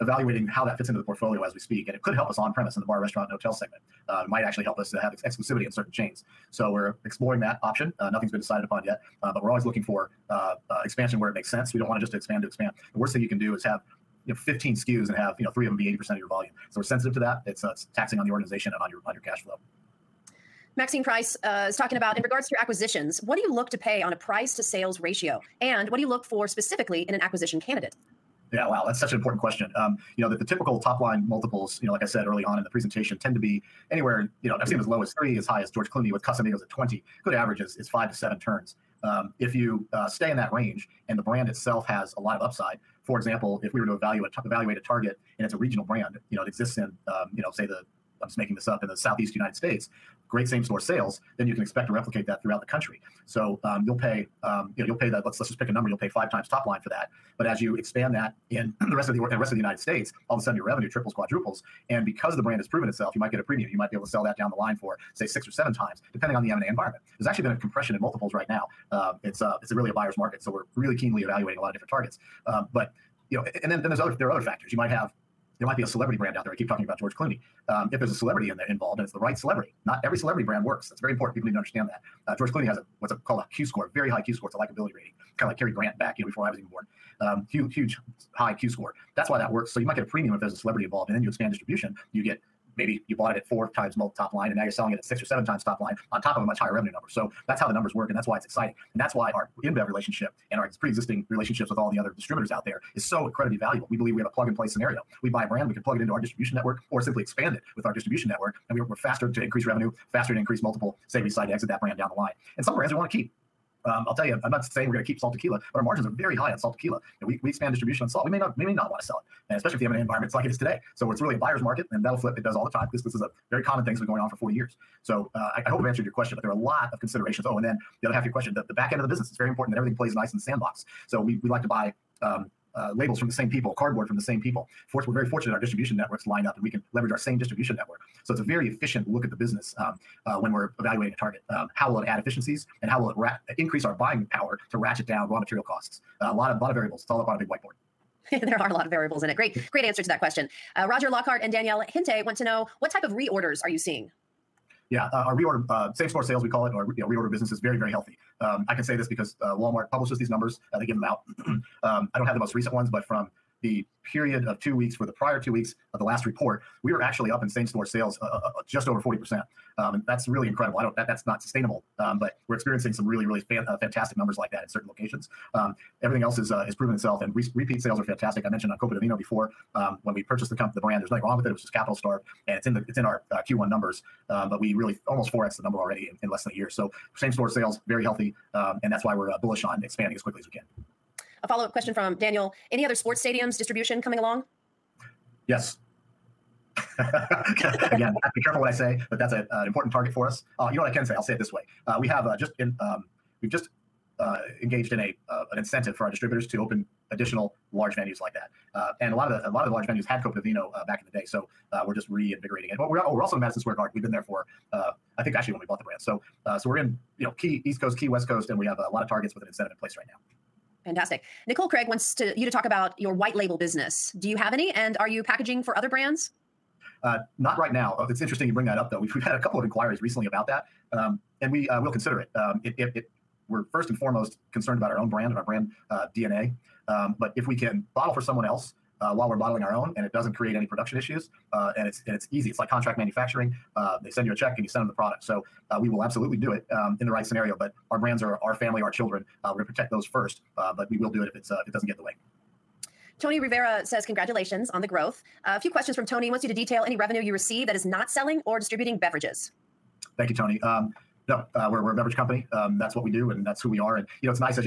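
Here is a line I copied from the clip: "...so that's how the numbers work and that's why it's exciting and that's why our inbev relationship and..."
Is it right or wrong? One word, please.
right.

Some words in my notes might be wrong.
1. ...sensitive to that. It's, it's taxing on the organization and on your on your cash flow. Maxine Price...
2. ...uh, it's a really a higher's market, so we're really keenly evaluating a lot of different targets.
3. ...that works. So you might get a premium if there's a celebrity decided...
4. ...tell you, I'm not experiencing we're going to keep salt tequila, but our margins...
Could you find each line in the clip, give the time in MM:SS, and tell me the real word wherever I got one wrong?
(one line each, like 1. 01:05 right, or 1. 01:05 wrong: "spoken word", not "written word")
1. 00:16 right
2. 01:09 wrong: "buyer", not "higher"
3. 01:29 wrong: "involved", not "decided"
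4. 01:54 wrong: "saying", not "experiencing".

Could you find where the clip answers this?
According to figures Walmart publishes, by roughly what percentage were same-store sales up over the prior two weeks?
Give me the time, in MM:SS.
02:48.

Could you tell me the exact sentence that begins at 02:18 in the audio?
So it's a very efficient look at the business um, uh, when we're evaluating a target.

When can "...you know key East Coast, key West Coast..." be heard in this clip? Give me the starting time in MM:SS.
03:37.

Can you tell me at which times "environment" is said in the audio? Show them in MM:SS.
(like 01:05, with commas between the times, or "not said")
01:06, 01:59.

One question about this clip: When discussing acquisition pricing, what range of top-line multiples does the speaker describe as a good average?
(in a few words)
5 to 7 turns.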